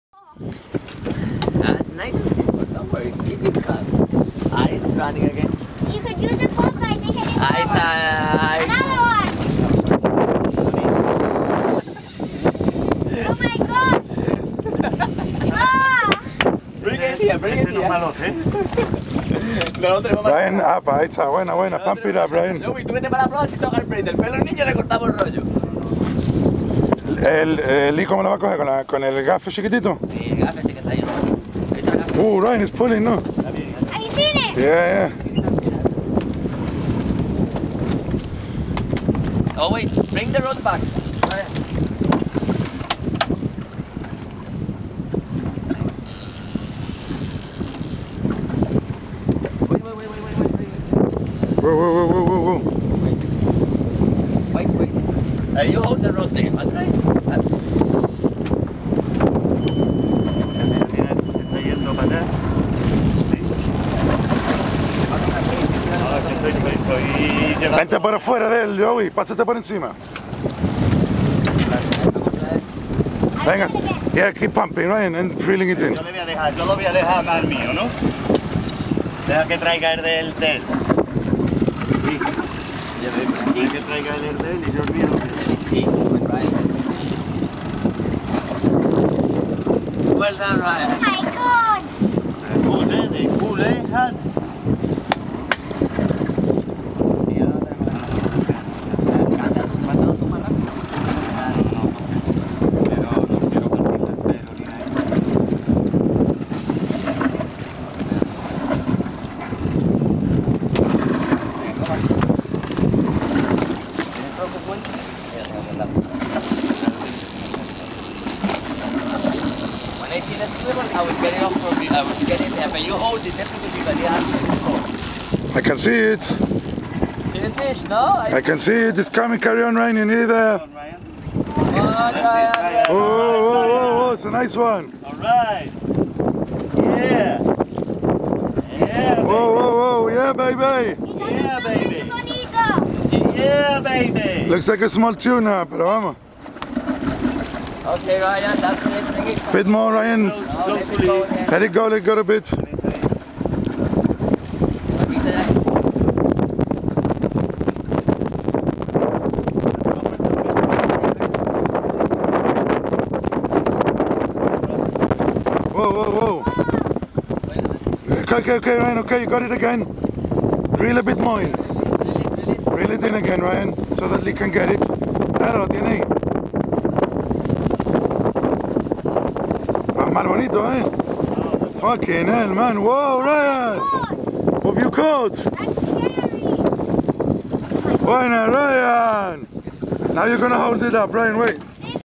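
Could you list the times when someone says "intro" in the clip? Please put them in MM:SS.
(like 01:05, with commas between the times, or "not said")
not said.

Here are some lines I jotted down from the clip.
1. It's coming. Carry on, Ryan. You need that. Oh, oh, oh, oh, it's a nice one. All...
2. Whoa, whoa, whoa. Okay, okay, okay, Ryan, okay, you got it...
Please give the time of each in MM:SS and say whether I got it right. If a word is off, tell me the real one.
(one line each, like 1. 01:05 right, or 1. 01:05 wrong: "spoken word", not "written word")
1. 02:08 right
2. 02:45 right.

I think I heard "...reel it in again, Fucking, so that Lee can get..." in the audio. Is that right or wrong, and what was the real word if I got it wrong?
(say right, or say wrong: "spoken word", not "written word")
wrong: "Ryan", not "Fucking".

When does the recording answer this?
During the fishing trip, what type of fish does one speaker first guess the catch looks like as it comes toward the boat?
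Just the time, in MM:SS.
02:24.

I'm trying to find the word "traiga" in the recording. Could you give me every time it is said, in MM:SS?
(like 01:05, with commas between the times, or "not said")
01:19, 01:23.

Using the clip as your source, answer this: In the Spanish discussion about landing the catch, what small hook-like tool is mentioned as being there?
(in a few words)
gafe chiquitito.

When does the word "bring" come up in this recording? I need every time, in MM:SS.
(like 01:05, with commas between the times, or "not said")
00:40, 02:29.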